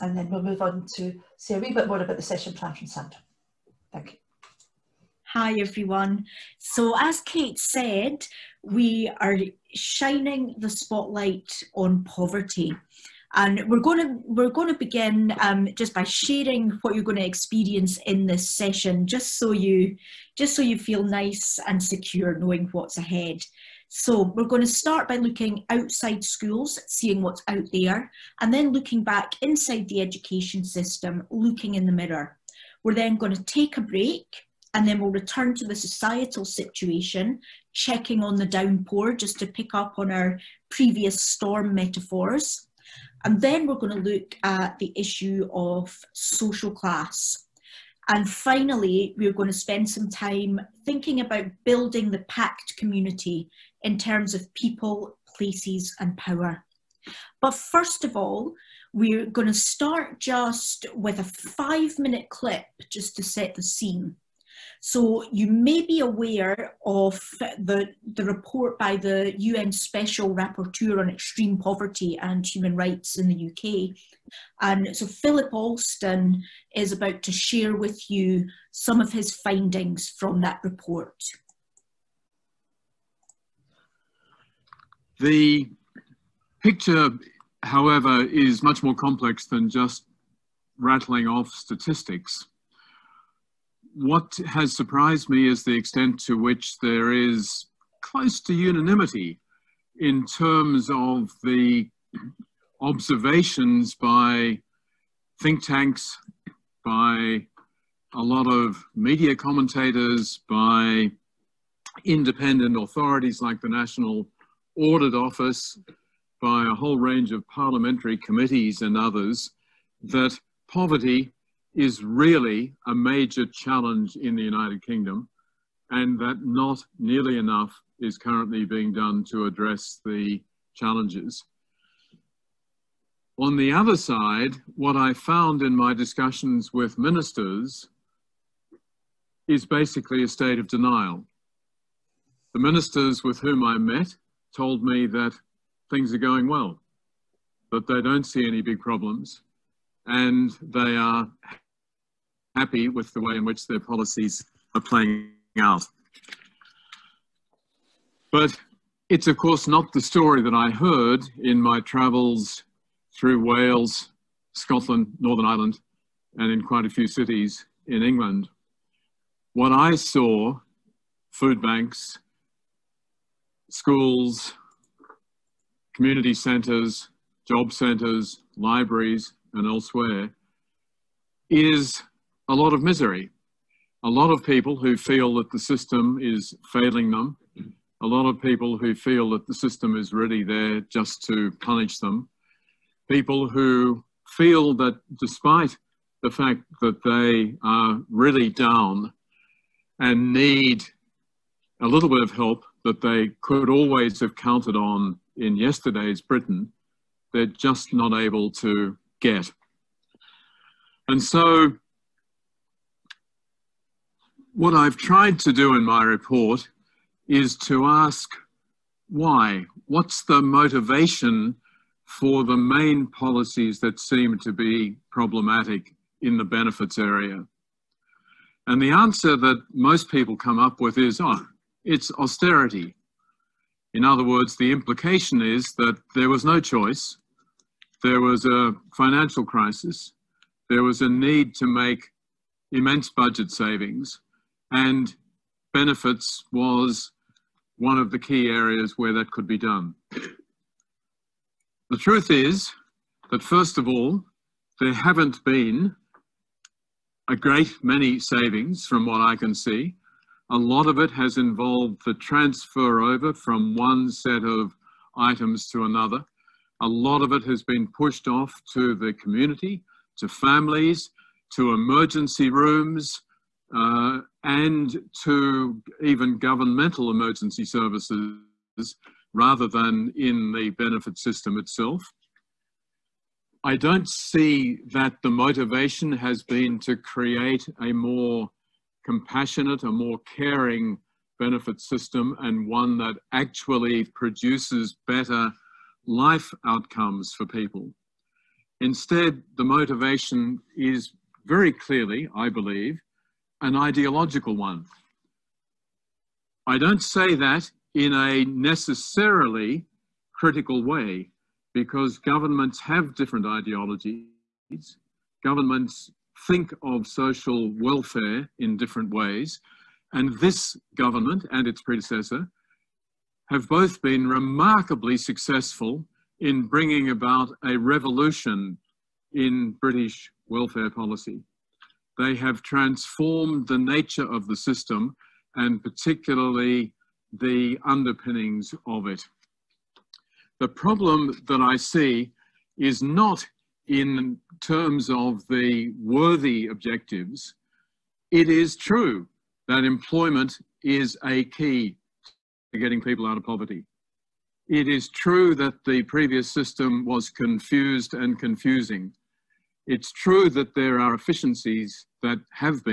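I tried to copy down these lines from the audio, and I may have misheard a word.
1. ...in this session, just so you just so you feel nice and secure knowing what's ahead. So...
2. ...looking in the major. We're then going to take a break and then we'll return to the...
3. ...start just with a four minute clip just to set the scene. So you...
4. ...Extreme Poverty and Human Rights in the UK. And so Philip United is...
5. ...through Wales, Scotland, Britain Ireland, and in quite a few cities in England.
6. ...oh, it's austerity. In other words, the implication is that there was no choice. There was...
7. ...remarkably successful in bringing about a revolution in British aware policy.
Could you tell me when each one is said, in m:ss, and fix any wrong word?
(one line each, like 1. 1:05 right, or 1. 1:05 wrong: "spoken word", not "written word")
1. 0:18 right
2. 0:31 wrong: "mirror", not "major"
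3. 0:59 wrong: "five", not "four"
4. 1:11 wrong: "Alston", not "United"
5. 2:43 wrong: "Northern", not "Britain"
6. 3:51 right
7. 5:24 wrong: "welfare", not "aware".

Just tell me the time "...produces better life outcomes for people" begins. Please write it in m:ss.
4:54.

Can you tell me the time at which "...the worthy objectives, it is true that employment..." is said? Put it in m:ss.
5:45.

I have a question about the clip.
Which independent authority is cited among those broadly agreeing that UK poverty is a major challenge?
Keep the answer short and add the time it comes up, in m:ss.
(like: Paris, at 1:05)
National Audit Office, at 1:53.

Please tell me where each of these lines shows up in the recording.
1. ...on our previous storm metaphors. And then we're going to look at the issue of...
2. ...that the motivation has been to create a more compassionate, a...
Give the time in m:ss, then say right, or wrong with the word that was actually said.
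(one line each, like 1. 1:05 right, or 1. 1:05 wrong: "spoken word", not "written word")
1. 0:39 right
2. 4:44 right.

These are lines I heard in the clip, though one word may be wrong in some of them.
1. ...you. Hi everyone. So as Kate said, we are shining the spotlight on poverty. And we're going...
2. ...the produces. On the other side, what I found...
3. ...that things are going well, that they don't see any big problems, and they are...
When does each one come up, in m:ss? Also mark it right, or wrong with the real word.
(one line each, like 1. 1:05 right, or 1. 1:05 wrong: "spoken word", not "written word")
1. 0:04 right
2. 2:10 wrong: "challenges", not "produces"
3. 2:25 right.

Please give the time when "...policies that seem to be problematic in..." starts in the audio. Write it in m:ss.
3:43.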